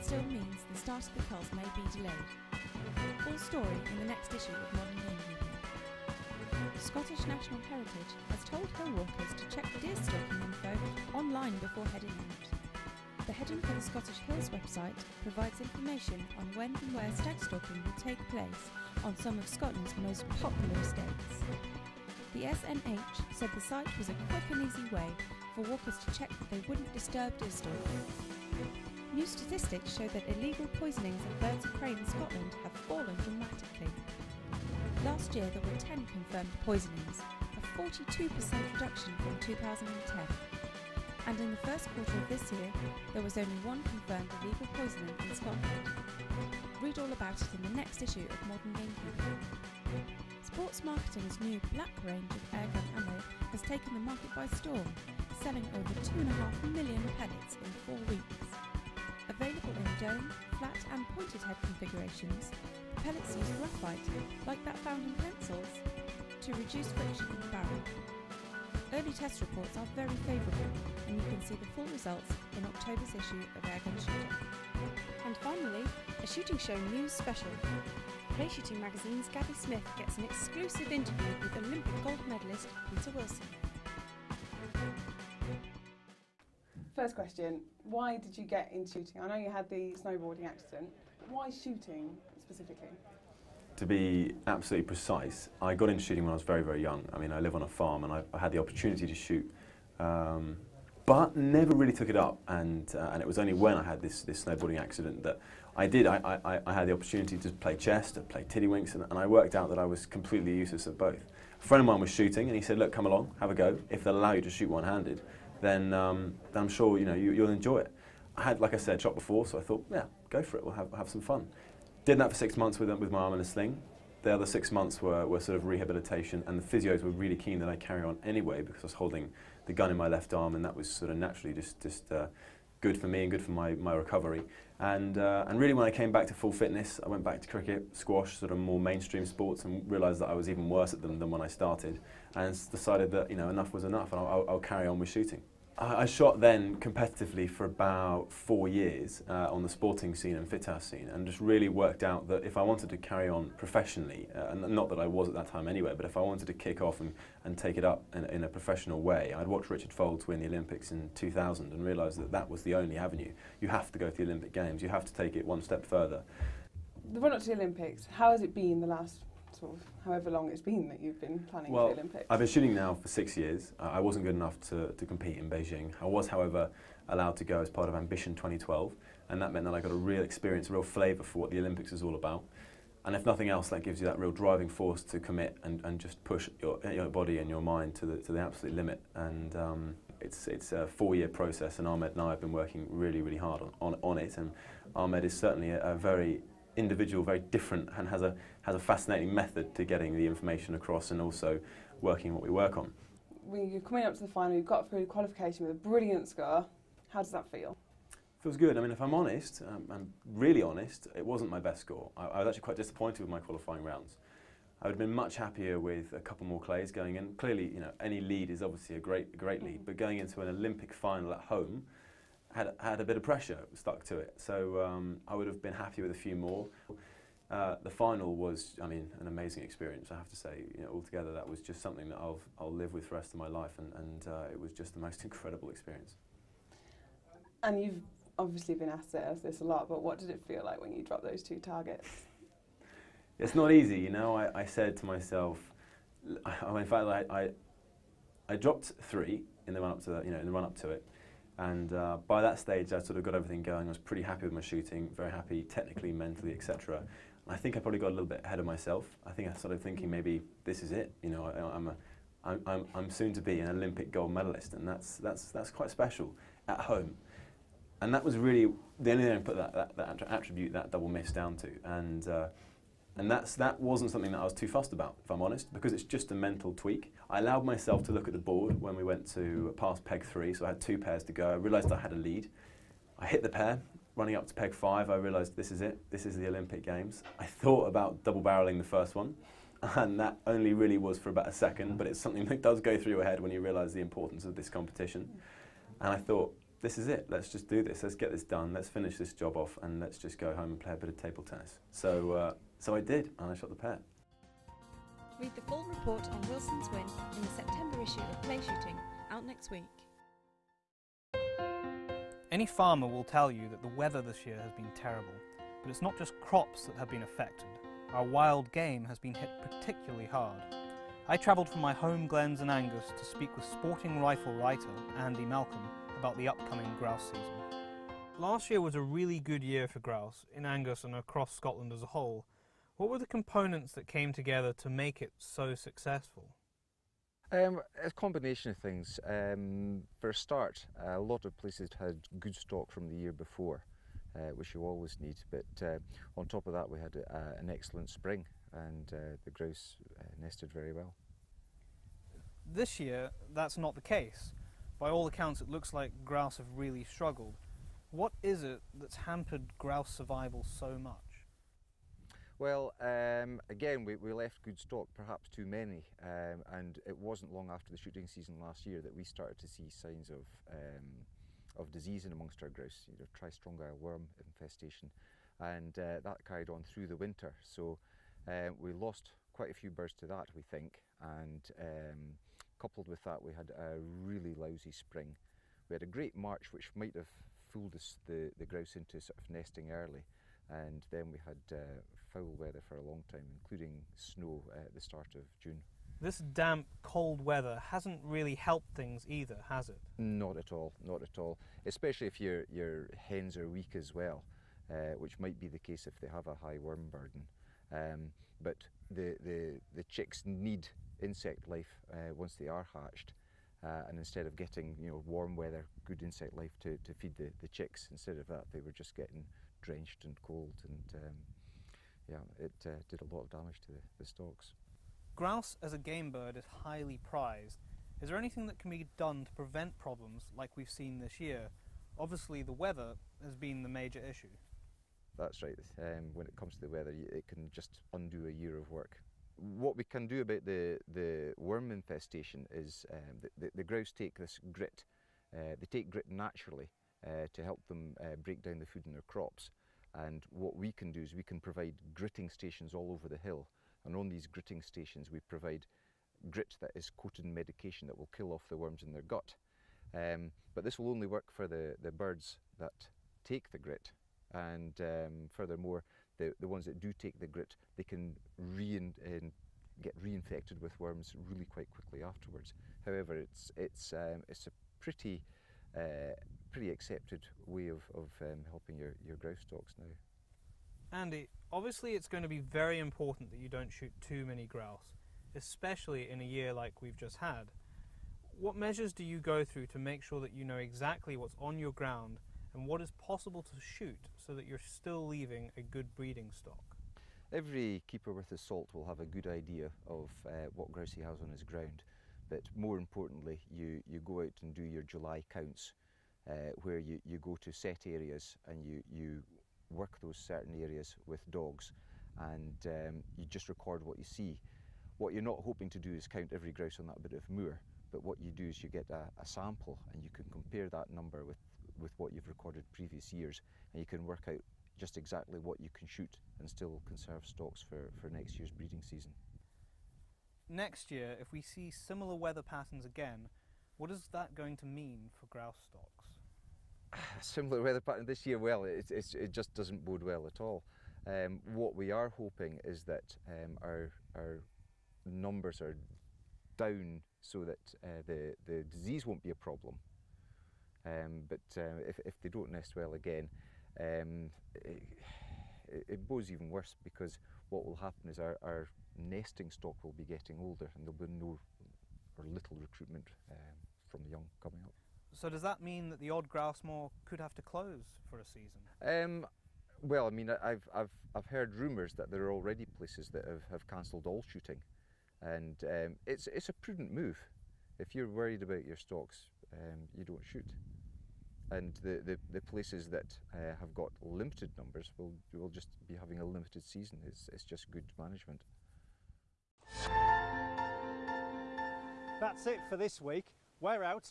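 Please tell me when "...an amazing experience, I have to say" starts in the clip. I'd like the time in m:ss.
3:49.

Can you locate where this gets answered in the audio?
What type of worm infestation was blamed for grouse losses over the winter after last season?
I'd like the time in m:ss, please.
6:13.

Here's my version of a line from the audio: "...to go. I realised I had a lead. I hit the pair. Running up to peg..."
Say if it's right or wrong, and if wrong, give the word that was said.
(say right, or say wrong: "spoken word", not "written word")
right.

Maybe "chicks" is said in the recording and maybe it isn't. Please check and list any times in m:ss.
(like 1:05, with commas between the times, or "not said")
6:50, 6:57.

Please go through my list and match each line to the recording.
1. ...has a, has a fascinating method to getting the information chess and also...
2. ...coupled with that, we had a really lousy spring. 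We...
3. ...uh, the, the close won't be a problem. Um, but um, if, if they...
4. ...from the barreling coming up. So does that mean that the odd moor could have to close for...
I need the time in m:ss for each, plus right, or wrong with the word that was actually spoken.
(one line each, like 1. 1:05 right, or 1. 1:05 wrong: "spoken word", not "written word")
1. 3:18 wrong: "across", not "chess"
2. 6:22 right
3. 9:08 wrong: "disease", not "close"
4. 9:24 wrong: "young", not "barreling".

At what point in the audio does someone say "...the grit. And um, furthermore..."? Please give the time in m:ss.
7:43.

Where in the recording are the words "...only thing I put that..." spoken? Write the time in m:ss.
4:29.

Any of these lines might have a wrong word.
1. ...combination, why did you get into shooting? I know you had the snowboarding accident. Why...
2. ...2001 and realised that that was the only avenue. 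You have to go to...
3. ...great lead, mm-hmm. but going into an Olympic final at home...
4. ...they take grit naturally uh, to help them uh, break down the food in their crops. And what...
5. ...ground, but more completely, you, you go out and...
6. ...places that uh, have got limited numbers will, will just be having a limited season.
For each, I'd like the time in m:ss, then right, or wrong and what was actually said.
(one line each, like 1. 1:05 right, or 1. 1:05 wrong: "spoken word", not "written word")
1. 1:27 wrong: "question", not "combination"
2. 2:41 wrong: "2000", not "2001"
3. 3:39 right
4. 7:25 right
5. 8:21 wrong: "importantly", not "completely"
6. 9:42 right.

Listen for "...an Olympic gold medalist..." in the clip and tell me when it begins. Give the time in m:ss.
4:23.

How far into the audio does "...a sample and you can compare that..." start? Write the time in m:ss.
8:39.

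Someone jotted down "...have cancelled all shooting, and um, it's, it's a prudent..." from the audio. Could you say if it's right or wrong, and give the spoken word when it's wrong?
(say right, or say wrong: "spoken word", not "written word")
right.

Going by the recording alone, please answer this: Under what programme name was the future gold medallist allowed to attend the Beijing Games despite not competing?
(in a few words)
Ambition 2012.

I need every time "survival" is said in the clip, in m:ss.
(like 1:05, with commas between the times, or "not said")
6:00.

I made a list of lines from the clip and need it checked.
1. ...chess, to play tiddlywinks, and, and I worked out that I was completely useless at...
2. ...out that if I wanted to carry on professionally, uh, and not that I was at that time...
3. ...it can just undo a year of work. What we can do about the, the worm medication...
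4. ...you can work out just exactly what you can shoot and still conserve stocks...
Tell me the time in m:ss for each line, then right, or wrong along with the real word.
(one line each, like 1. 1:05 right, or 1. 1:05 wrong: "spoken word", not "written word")
1. 1:47 right
2. 2:32 right
3. 7:17 wrong: "infestation", not "medication"
4. 8:44 right.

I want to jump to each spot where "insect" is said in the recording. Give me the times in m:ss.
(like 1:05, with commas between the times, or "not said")
6:51, 6:56.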